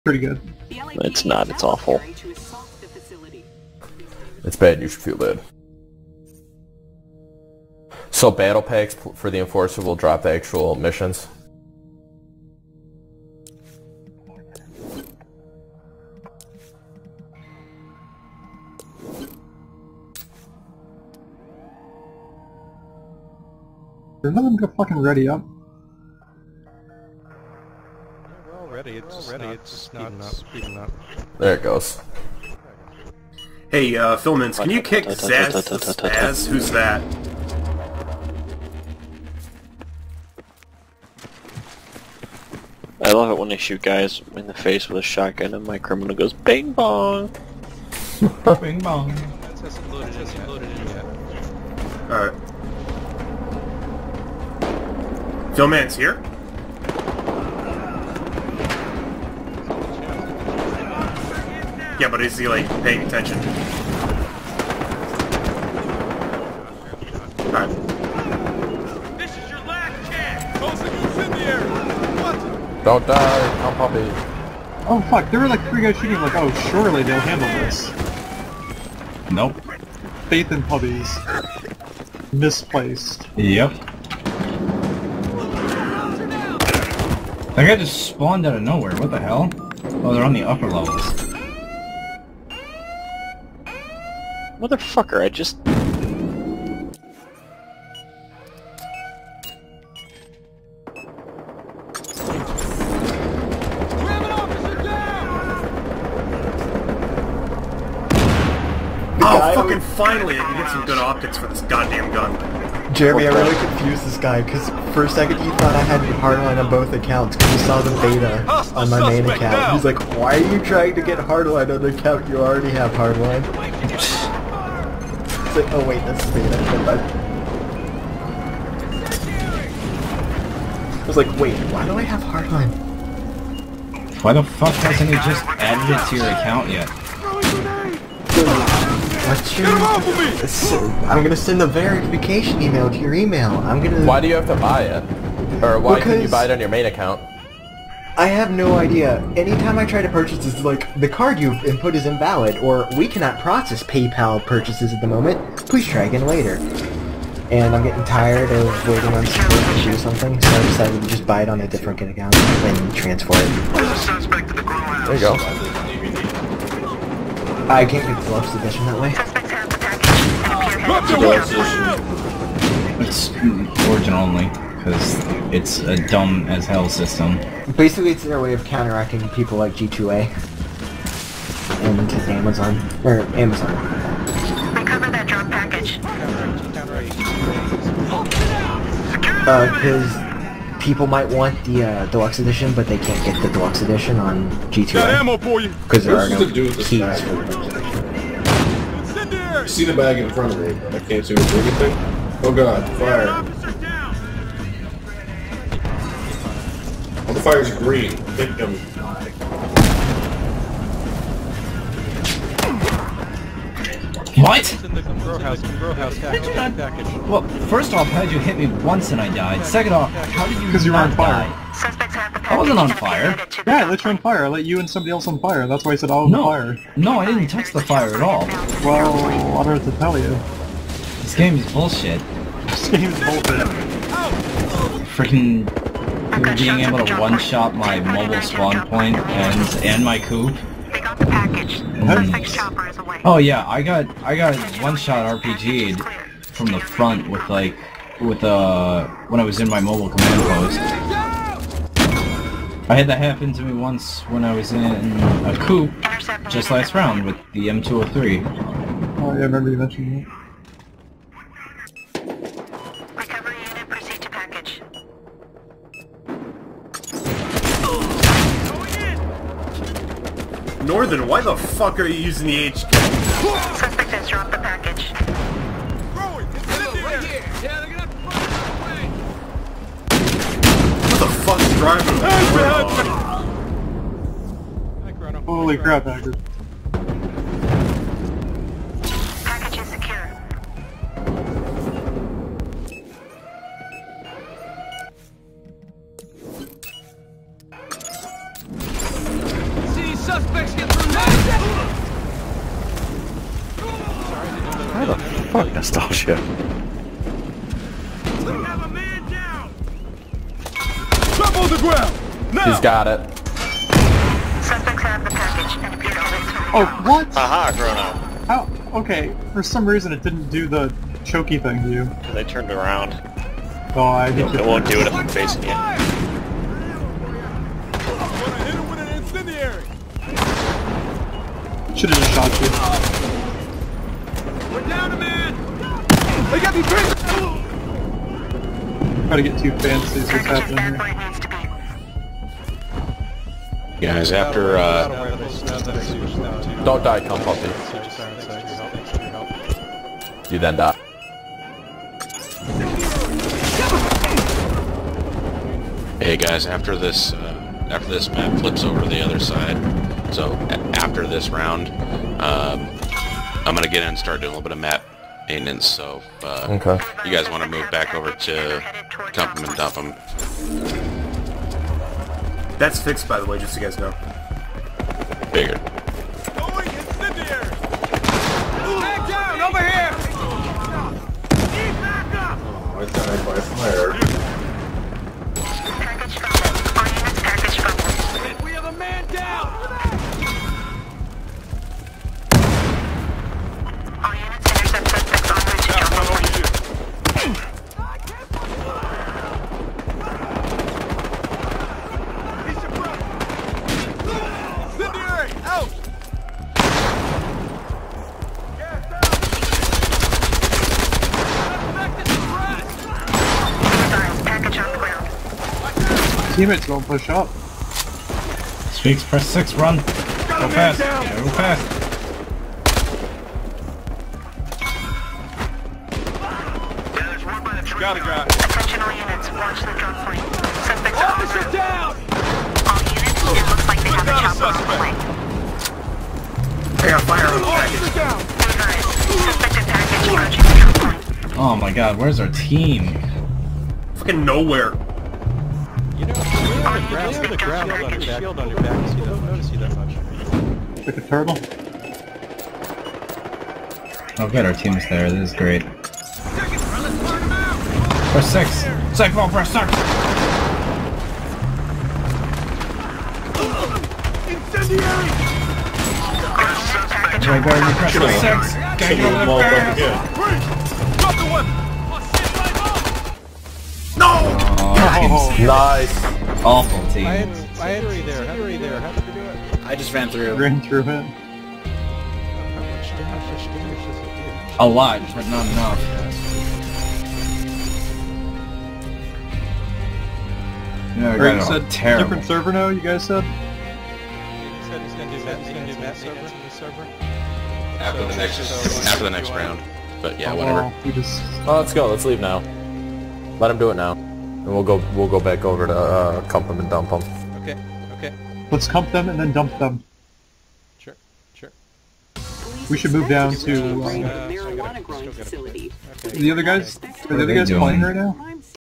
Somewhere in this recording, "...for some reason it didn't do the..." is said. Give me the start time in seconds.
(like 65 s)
319 s.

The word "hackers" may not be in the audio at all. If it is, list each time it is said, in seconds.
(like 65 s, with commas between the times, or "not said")
286 s.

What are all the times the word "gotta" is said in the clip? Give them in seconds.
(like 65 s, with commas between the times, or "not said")
514 s.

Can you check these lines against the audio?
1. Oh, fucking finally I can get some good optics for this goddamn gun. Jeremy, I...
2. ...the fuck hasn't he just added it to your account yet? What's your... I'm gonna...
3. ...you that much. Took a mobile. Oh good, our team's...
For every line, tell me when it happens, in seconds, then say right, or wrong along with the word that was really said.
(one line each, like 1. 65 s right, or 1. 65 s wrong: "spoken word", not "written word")
1. 109 s right
2. 134 s right
3. 449 s wrong: "turtle", not "mobile".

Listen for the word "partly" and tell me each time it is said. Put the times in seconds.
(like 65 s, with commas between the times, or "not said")
not said.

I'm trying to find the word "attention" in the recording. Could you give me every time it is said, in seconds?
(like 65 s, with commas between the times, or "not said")
63 s, 428 s.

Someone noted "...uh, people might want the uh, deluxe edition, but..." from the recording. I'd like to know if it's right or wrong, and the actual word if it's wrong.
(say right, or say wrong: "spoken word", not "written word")
right.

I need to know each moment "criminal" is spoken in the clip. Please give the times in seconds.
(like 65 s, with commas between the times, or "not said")
45 s.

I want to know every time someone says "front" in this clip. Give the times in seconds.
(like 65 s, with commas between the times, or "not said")
200 s, 246 s.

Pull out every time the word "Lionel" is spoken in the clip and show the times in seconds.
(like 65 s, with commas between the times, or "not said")
not said.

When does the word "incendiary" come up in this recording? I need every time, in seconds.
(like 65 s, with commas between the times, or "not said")
376 s, 464 s.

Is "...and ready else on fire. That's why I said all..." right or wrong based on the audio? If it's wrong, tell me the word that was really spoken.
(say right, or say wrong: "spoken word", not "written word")
wrong: "somebody", not "ready".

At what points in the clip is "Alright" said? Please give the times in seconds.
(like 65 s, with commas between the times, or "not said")
52 s.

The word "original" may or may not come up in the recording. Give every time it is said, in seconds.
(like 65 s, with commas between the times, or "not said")
173 s.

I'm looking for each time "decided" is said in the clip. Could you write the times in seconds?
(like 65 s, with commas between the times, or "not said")
160 s.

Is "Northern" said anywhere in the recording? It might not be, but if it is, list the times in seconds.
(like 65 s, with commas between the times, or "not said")
270 s.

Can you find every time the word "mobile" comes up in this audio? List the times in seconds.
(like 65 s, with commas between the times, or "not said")
237 s, 249 s.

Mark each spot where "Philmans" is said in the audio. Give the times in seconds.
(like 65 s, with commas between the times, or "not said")
34 s, 55 s.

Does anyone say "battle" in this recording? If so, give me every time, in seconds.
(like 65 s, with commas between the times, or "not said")
8 s.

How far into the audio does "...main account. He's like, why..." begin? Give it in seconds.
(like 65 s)
119 s.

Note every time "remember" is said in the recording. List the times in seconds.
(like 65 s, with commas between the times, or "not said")
236 s, 259 s.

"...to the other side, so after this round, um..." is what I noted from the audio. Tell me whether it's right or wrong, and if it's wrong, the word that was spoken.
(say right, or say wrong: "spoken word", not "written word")
right.